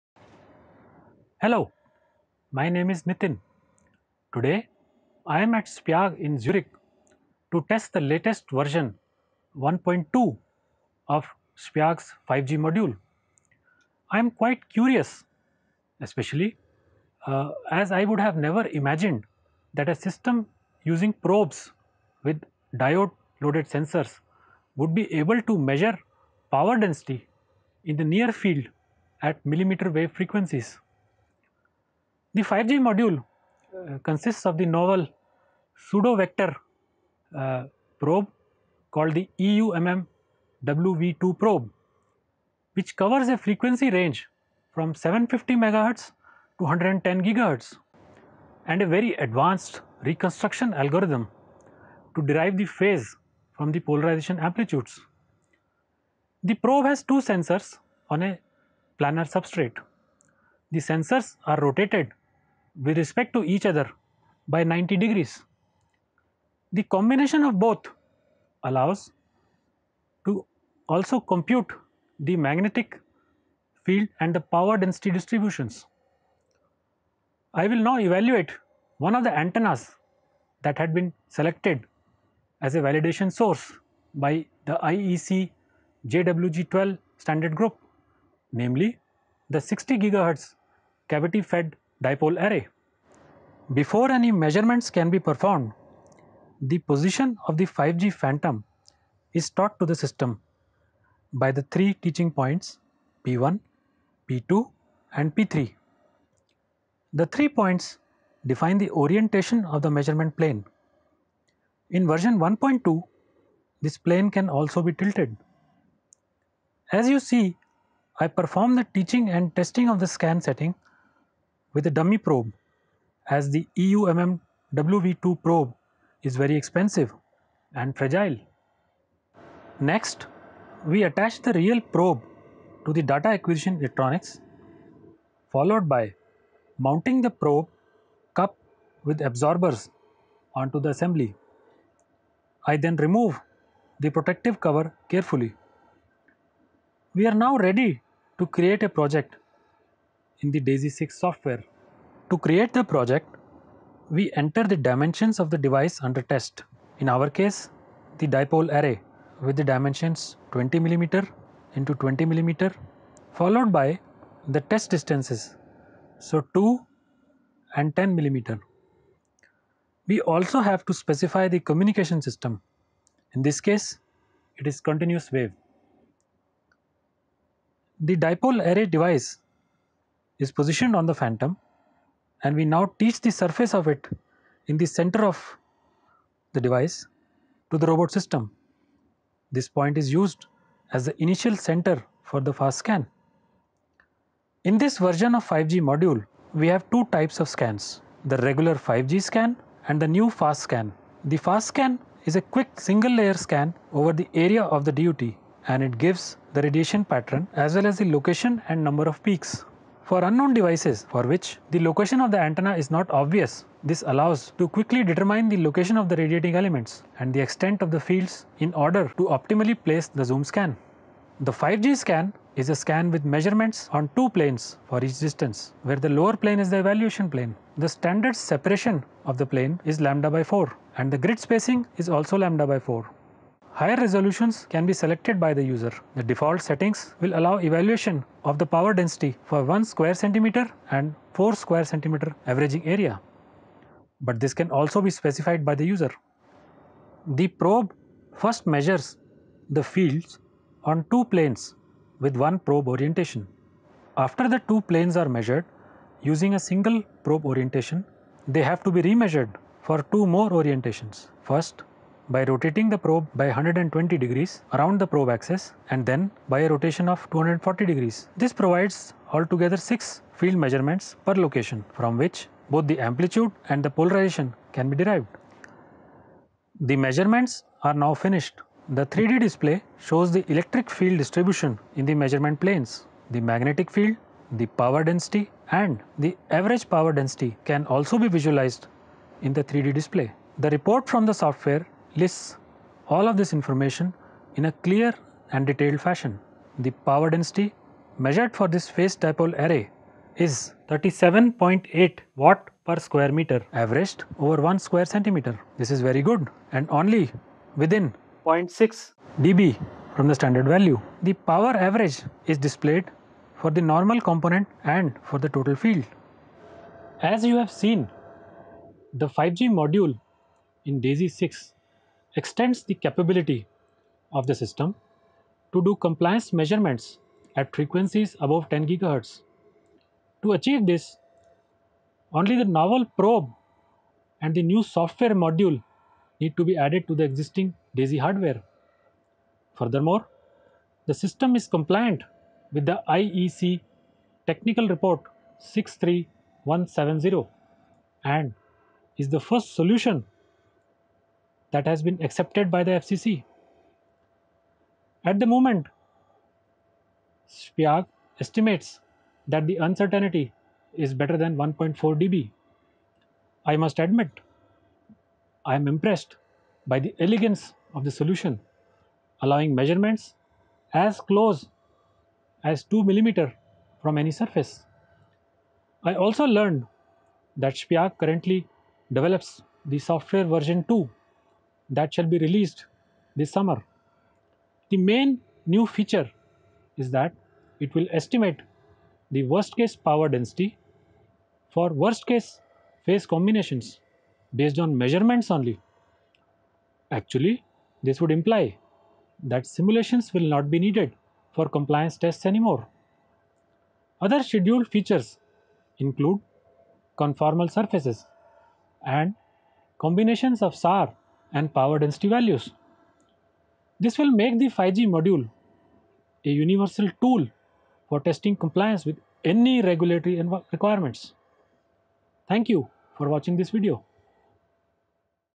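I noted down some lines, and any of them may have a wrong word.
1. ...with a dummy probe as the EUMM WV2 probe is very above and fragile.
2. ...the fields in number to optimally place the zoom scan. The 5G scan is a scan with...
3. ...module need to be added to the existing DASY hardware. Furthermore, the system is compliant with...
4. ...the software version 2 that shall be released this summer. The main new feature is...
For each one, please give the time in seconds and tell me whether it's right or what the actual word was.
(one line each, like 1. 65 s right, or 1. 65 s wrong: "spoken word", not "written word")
1. 121 s wrong: "expensive", not "above"
2. 217 s wrong: "order", not "number"
3. 335 s right
4. 379 s right.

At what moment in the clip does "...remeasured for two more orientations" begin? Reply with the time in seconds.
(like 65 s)
259 s.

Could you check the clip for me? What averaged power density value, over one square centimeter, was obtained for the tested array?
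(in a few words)
37.8 W/m².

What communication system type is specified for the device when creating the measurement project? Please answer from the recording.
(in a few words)
Continuous wave.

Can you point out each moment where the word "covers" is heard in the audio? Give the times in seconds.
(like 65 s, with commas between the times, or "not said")
42 s, 144 s.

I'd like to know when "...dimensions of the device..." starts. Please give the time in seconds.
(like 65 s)
154 s.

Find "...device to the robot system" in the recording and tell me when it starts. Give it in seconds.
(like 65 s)
186 s.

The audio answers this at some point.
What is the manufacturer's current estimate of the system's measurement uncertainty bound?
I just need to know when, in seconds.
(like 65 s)
361 s.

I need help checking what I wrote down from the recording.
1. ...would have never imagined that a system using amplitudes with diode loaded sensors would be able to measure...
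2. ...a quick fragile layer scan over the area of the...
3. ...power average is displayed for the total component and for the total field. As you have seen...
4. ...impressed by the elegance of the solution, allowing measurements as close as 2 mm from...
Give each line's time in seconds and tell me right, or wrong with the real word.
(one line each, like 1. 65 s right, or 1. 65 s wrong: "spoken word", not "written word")
1. 18 s wrong: "probes", not "amplitudes"
2. 202 s wrong: "single", not "fragile"
3. 311 s wrong: "normal", not "total"
4. 365 s right.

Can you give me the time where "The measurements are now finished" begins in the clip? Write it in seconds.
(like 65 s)
276 s.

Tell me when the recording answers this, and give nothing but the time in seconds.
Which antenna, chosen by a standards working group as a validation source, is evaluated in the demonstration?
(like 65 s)
89 s.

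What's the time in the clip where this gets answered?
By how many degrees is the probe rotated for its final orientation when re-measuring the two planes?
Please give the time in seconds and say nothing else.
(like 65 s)
267 s.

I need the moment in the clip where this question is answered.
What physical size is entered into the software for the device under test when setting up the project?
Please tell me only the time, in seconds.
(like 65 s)
160 s.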